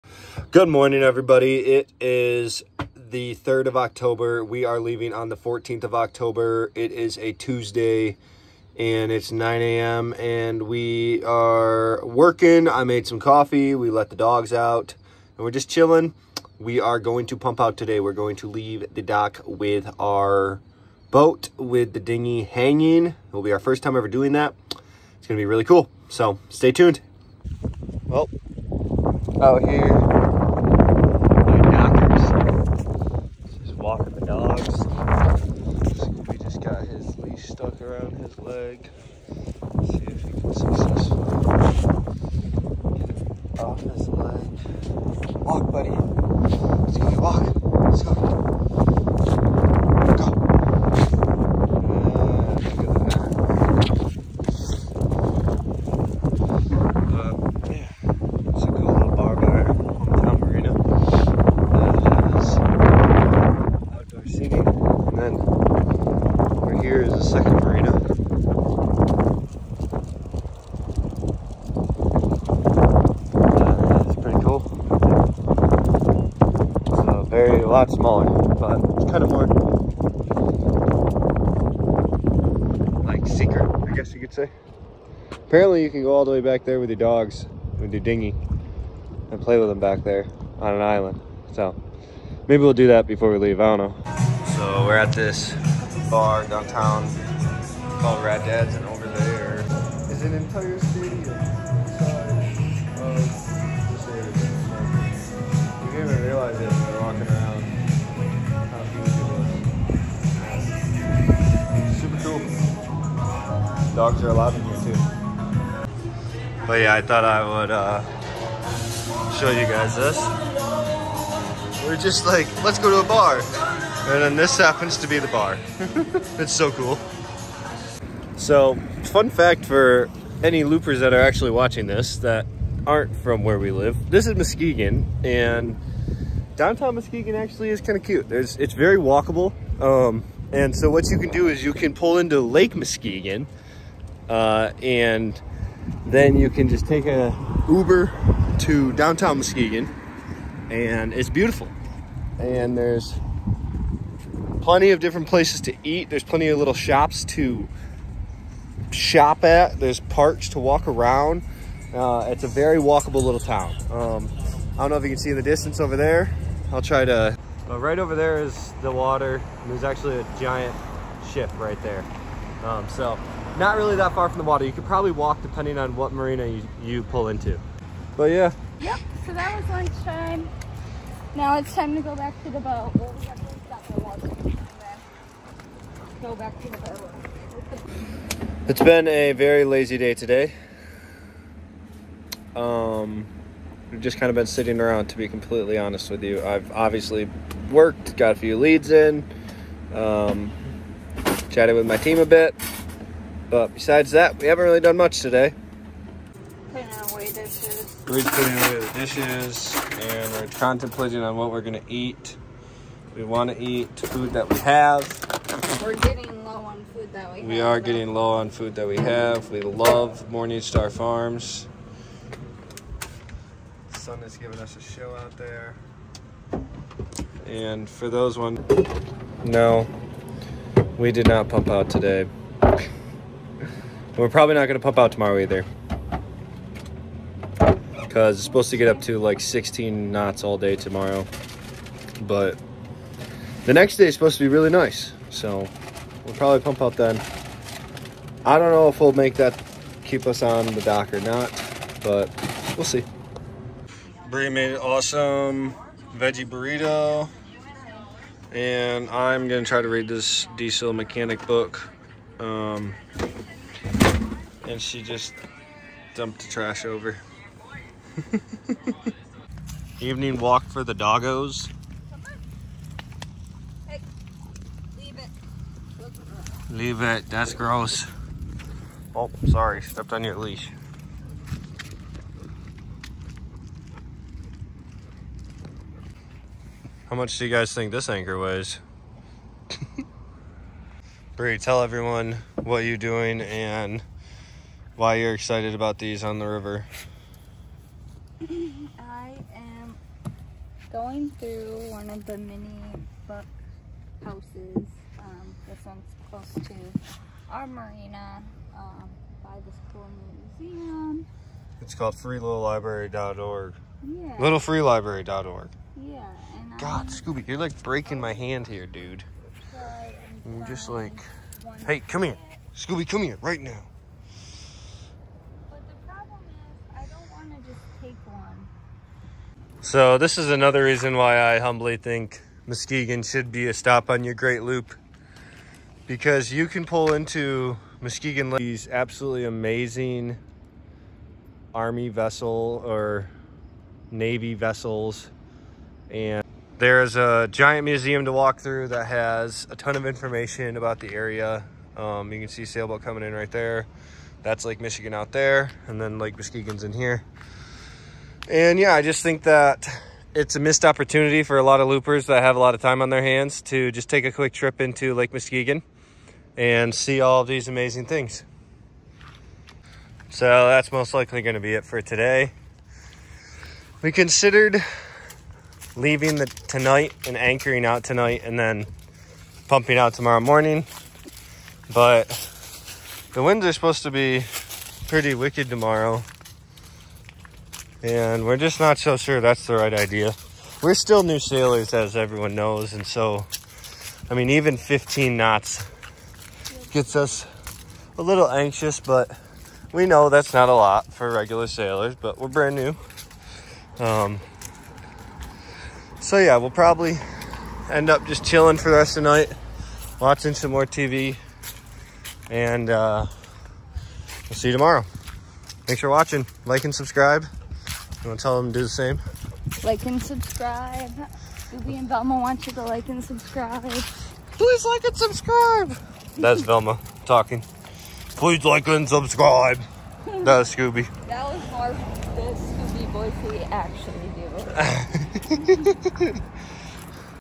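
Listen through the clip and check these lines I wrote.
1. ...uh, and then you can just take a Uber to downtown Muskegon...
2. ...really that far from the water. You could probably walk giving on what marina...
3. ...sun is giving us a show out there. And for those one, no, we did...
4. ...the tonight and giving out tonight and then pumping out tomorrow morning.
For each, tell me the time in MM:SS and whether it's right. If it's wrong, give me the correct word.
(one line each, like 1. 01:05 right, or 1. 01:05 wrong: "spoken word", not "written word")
1. 02:24 right
2. 02:53 wrong: "depending", not "giving"
3. 03:43 right
4. 06:16 wrong: "anchoring", not "giving".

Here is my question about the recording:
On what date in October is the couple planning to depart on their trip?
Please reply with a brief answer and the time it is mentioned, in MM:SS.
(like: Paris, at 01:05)
14th of October, at 00:05.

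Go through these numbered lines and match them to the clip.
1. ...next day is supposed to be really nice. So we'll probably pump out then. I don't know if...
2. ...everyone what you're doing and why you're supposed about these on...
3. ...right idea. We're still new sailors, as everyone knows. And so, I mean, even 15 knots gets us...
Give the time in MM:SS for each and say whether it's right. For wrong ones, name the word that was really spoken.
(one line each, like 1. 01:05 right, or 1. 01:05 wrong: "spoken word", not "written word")
1. 04:03 right
2. 04:51 wrong: "excited", not "supposed"
3. 06:29 right.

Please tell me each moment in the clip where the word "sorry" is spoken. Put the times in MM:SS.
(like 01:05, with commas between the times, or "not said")
04:39.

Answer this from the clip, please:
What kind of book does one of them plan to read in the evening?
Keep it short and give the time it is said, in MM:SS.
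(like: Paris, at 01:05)
diesel mechanic book, at 04:20.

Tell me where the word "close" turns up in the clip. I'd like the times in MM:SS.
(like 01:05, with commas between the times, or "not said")
05:06.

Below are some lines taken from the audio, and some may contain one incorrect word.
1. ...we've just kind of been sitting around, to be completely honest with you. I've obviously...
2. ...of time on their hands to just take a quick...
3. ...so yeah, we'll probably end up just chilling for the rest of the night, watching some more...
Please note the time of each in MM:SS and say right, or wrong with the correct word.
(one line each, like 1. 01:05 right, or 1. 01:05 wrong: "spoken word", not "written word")
1. 03:13 right
2. 06:02 right
3. 06:46 right.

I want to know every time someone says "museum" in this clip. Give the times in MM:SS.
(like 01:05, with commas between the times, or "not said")
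05:10, 05:47.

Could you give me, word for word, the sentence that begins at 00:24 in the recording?
It's going to be really cool.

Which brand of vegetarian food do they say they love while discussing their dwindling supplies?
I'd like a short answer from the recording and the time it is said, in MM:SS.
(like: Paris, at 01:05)
Morningstar Farms, at 03:40.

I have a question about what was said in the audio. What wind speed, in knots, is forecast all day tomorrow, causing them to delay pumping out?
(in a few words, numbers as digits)
16.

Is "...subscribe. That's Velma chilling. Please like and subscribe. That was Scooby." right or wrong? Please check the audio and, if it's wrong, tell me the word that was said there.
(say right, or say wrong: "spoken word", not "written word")
wrong: "talking", not "chilling".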